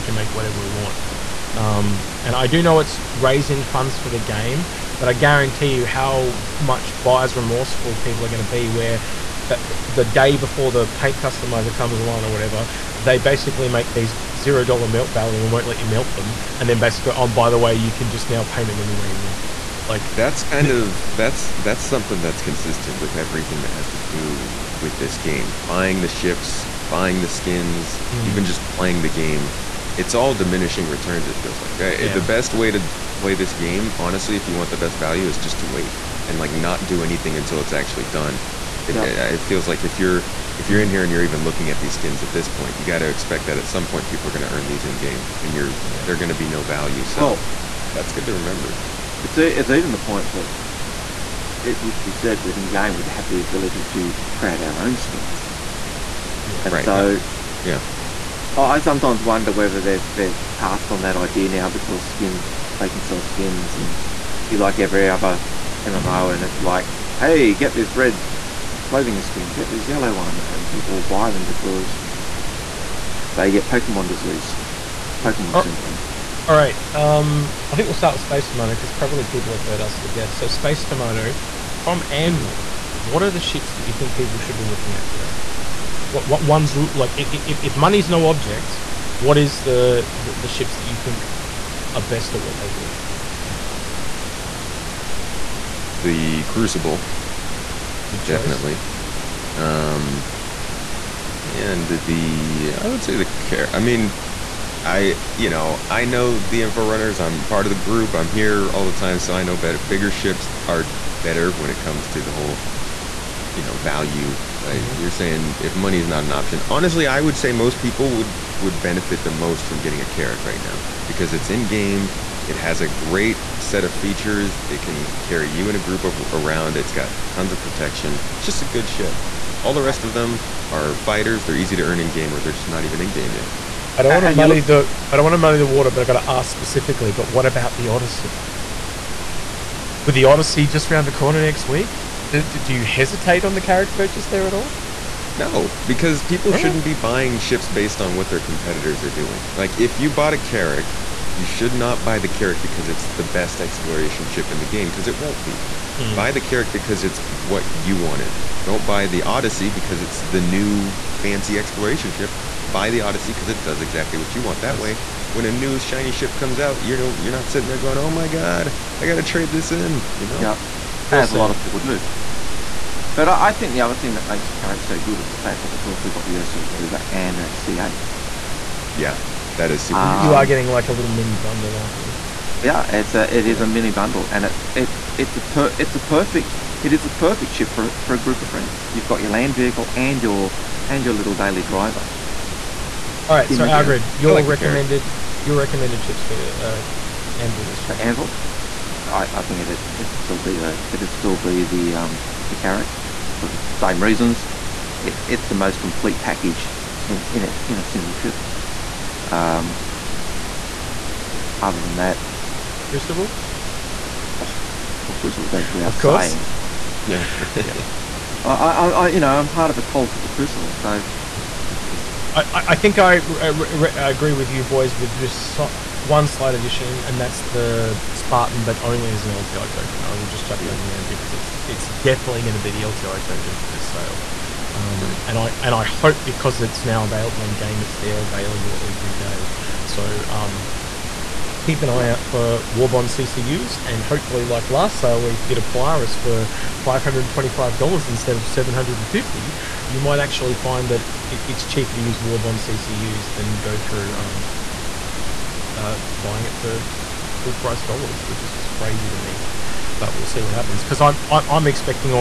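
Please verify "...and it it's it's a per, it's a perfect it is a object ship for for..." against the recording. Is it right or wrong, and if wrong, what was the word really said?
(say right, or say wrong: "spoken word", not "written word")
wrong: "perfect", not "object".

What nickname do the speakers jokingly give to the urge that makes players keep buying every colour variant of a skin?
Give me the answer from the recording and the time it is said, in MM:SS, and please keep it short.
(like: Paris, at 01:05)
Pokemon disease, at 01:13.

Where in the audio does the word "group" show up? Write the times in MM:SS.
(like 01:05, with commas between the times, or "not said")
01:47, 02:05, 03:08.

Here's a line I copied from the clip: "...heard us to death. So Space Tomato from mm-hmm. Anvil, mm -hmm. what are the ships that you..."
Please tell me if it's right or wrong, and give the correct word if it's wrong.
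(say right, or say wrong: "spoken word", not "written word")
right.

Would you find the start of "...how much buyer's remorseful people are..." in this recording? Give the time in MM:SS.
00:05.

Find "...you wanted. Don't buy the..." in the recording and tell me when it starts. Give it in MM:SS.
02:37.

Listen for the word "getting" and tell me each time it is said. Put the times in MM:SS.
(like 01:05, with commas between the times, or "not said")
01:59, 03:00.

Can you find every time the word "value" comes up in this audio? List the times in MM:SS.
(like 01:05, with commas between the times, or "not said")
00:15, 00:34, 00:46, 01:53.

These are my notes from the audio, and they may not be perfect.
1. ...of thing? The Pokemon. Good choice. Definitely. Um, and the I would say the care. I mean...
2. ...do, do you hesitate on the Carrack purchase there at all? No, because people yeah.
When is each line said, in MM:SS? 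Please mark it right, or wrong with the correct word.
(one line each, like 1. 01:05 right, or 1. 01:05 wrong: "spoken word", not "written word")
1. 01:33 wrong: "Crucible", not "Pokemon"
2. 02:22 right.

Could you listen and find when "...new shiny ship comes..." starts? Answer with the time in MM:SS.
02:45.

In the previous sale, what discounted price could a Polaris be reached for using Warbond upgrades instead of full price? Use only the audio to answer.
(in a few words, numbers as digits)
$525.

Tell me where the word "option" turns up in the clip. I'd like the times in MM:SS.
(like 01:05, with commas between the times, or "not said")
01:56.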